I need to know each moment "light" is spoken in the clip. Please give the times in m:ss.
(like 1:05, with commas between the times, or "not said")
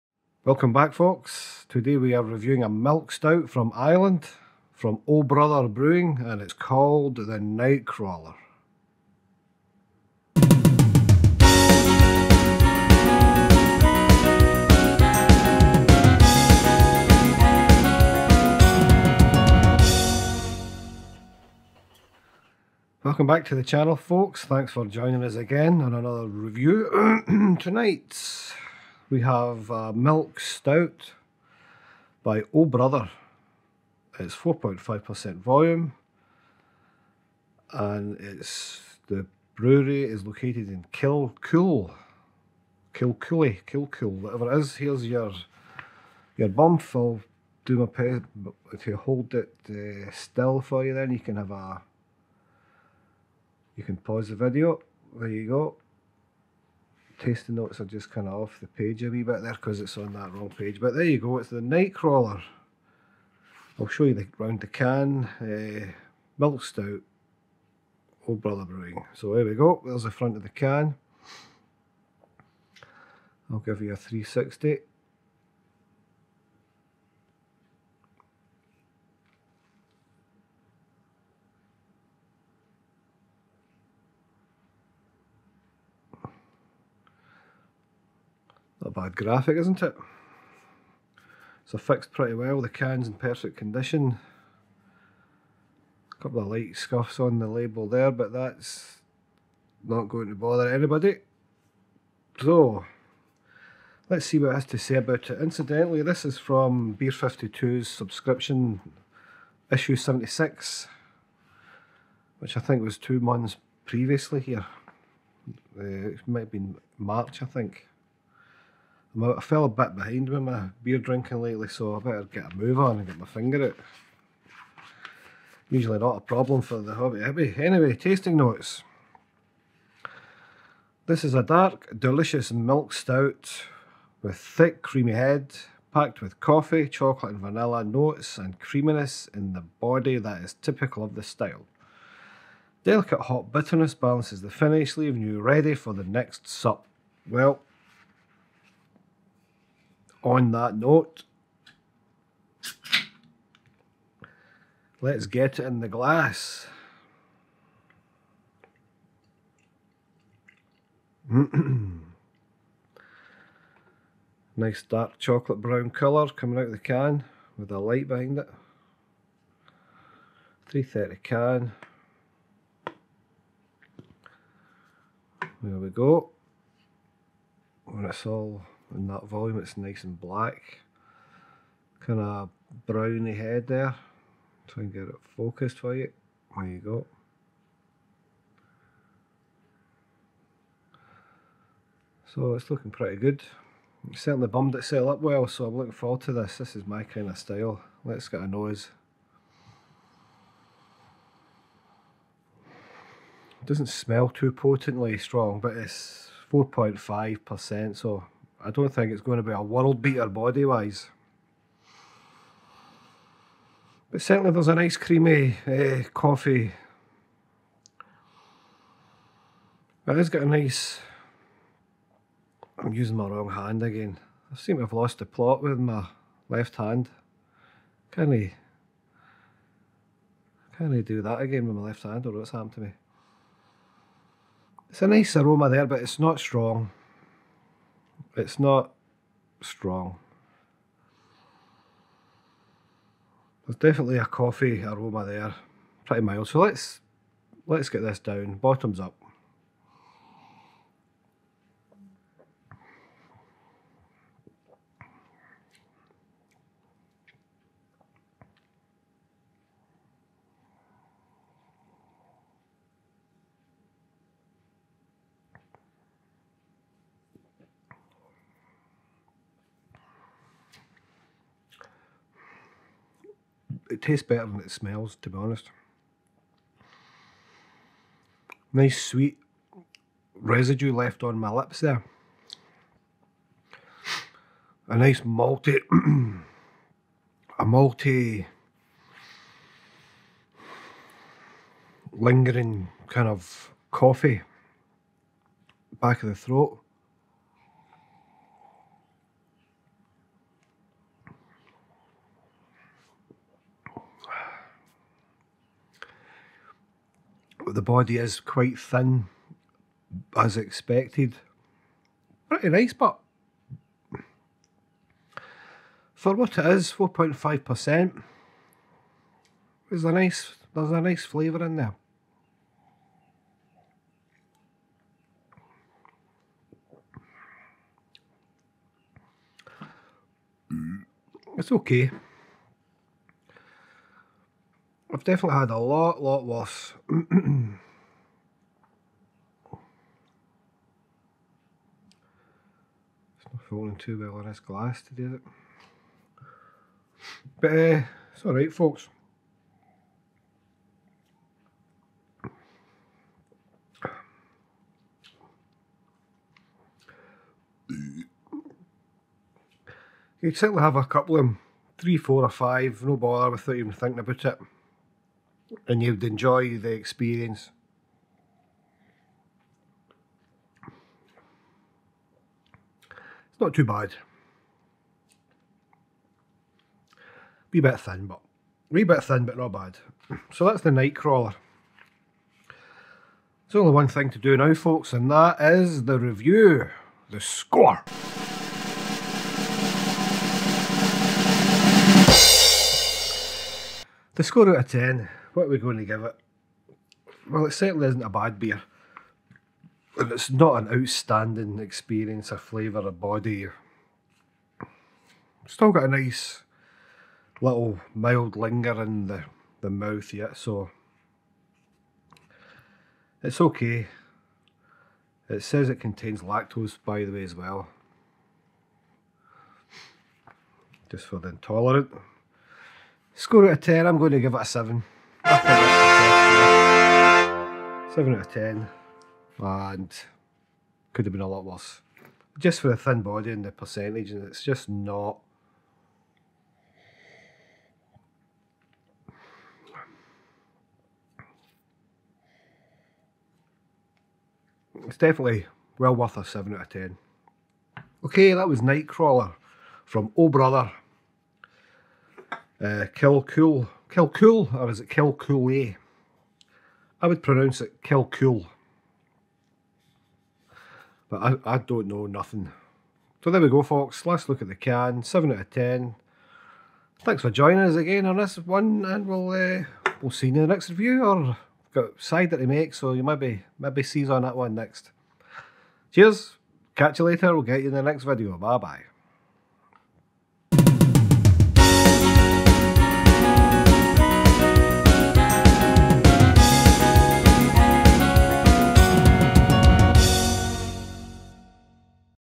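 1:36, 2:47.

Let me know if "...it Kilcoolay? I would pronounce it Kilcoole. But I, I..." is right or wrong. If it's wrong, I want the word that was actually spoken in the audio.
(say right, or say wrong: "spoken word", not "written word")
right.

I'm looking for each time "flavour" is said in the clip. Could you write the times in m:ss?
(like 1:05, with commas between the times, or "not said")
5:21, 6:42.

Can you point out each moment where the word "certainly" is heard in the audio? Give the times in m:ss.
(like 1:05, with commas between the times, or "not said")
3:14, 3:34, 6:00, 6:37.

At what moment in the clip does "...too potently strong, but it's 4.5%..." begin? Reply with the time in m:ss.
3:24.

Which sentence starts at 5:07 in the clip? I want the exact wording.
the body is quite thin, as expected.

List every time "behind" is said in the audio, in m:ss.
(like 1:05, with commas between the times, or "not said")
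1:59, 2:48.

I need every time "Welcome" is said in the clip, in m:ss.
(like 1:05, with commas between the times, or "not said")
0:00, 0:23.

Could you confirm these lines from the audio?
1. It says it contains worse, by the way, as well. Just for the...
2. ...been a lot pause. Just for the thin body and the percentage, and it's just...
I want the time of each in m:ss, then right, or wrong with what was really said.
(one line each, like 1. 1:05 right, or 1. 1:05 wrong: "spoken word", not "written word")
1. 6:55 wrong: "lactose", not "worse"
2. 7:11 wrong: "worse", not "pause".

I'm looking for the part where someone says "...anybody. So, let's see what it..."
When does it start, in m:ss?
1:40.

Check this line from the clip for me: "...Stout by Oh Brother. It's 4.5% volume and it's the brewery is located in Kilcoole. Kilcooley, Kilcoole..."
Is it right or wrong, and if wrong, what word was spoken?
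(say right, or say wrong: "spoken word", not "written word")
right.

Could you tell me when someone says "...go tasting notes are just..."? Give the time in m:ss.
0:55.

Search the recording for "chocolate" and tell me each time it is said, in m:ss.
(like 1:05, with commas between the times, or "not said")
2:16, 2:45.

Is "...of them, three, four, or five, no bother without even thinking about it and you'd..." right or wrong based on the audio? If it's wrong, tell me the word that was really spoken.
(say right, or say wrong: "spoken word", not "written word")
right.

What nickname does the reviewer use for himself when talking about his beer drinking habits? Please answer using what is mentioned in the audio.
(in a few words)
Hoppy Hippie.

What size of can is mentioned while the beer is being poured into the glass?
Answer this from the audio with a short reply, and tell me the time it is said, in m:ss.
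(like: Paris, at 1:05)
330, at 2:50.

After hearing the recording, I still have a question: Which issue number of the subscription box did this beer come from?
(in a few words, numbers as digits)
76.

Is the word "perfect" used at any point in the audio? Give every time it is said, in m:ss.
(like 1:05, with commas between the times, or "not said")
1:33.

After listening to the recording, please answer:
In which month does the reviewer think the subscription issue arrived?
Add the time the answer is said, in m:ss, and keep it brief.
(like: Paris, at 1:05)
March, at 1:56.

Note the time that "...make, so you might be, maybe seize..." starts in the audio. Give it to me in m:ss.
7:52.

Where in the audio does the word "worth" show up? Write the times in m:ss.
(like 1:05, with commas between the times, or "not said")
7:26.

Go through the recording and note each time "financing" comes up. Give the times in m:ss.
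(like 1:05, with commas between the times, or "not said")
not said.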